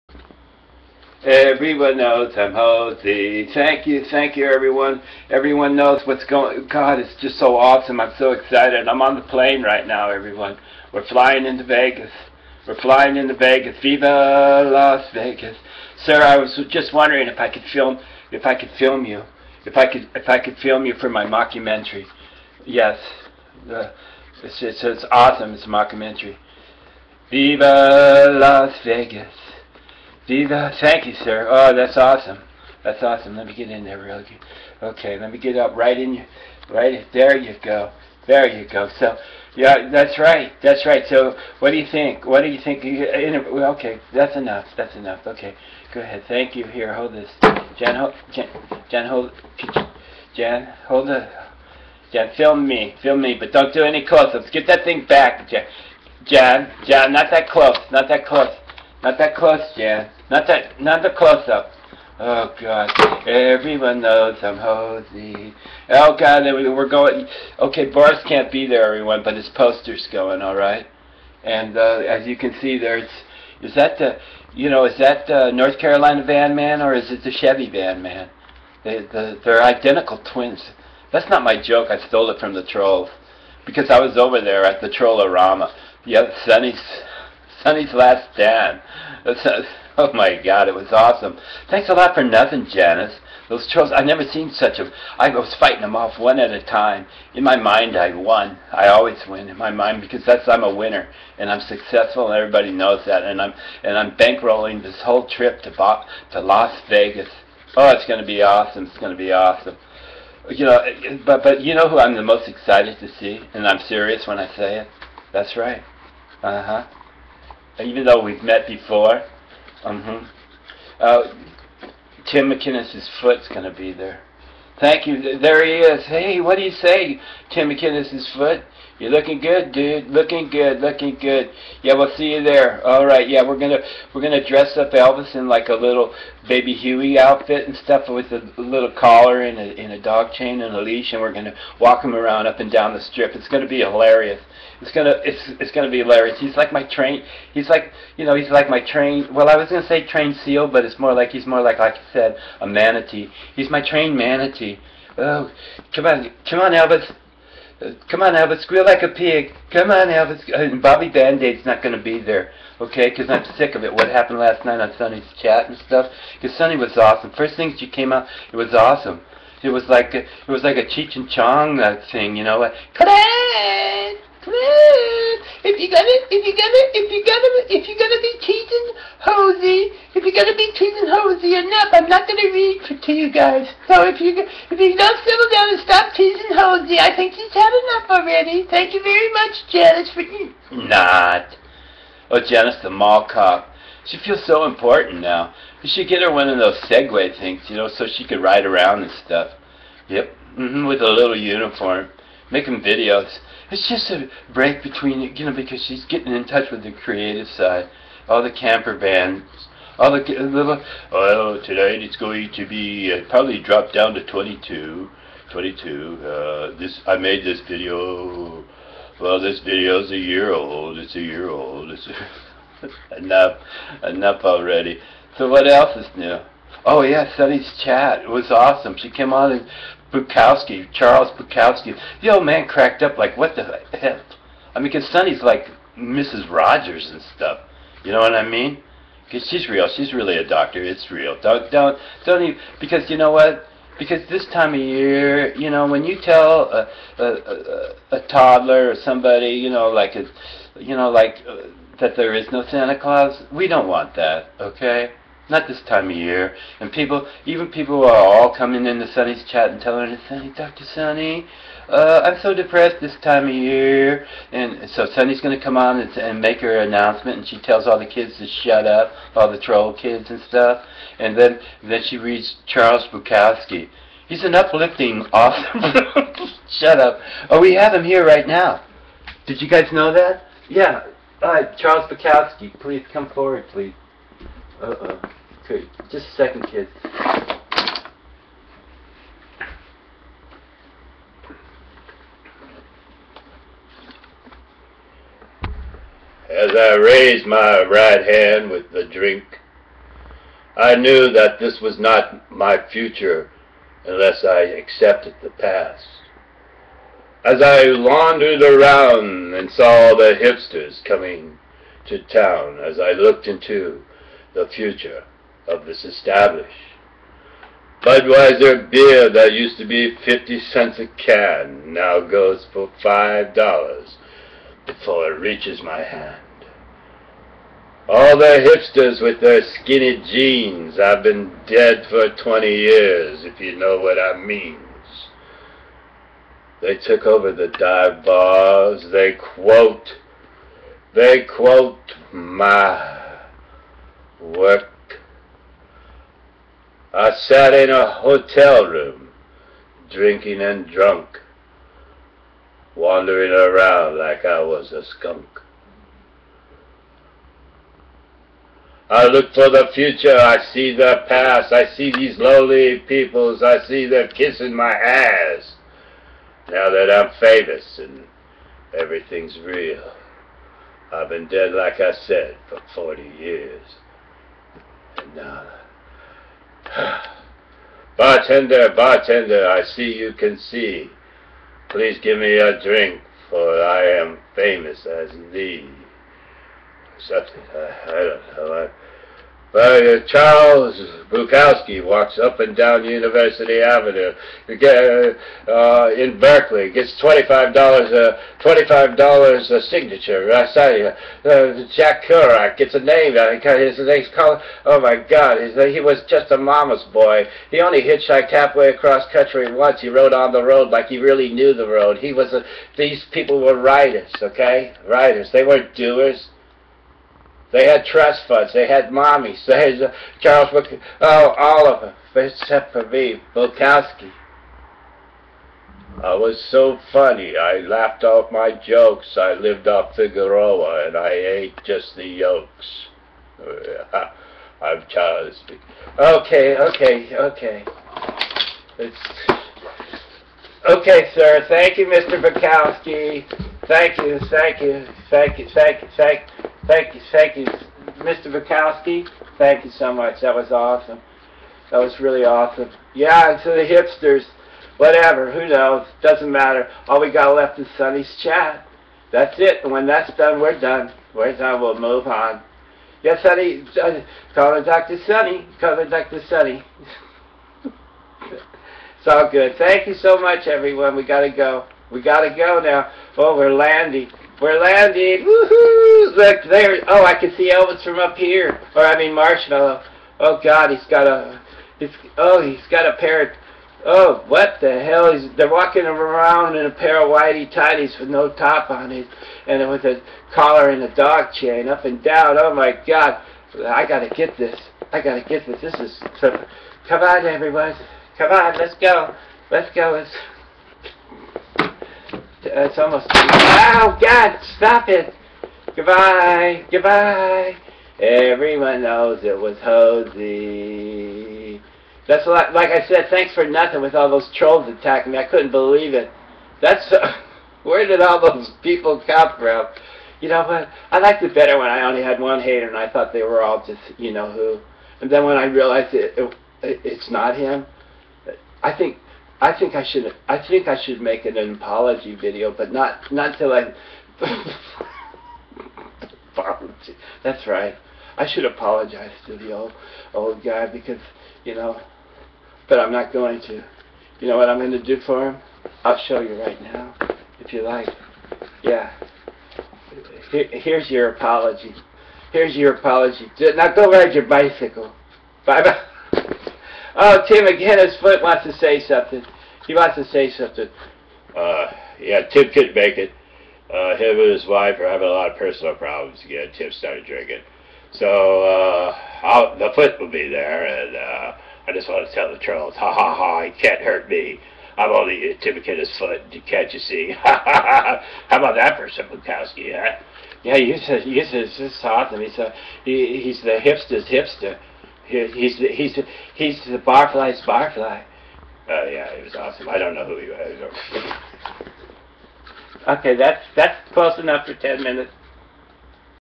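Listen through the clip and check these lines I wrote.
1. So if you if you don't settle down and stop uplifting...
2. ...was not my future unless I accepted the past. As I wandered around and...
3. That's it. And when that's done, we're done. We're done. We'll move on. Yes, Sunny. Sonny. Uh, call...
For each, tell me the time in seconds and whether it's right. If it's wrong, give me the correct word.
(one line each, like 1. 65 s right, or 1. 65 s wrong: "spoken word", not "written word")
1. 183 s wrong: "teasing", not "uplifting"
2. 301 s right
3. 459 s right.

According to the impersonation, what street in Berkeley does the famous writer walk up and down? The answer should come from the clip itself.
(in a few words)
University Avenue.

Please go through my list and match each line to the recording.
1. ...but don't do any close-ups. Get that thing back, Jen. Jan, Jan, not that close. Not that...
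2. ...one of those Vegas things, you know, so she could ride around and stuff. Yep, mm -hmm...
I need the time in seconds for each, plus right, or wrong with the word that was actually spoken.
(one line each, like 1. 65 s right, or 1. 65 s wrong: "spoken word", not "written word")
1. 53 s right
2. 196 s wrong: "Segway", not "Vegas".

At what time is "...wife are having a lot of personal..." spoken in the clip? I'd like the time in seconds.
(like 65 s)
564 s.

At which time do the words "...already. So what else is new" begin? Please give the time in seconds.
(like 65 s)
224 s.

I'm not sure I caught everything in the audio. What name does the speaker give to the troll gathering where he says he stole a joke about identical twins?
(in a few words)
Trollorama.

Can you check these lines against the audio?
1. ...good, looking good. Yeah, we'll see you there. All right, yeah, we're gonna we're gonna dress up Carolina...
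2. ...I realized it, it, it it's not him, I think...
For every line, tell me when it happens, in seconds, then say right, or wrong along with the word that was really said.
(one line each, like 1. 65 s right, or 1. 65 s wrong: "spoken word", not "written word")
1. 130 s wrong: "Elvis", not "Carolina"
2. 525 s right.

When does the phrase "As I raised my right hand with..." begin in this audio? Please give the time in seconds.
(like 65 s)
296 s.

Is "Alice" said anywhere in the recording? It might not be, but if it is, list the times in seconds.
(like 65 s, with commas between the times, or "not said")
not said.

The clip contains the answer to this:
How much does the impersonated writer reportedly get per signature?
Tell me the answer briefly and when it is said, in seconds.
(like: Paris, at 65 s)
$25, at 398 s.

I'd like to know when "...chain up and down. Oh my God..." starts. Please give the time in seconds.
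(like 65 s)
491 s.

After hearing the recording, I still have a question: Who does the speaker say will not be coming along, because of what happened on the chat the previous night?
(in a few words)
Bobby Band-Aid.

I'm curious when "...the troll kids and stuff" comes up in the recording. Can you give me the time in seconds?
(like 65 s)
269 s.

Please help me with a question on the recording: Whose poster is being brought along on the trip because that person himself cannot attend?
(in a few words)
Boris.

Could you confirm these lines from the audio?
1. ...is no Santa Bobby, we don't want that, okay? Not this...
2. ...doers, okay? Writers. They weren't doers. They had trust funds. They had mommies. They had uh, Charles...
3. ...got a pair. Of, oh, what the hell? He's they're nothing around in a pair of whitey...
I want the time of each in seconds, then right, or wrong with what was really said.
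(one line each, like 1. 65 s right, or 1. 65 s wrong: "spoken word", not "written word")
1. 252 s wrong: "Claus", not "Bobby"
2. 413 s wrong: "writers", not "doers"
3. 482 s wrong: "walking", not "nothing".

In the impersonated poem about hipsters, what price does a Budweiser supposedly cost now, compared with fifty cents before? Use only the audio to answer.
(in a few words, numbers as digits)
$5.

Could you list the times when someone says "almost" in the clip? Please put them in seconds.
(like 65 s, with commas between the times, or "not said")
503 s.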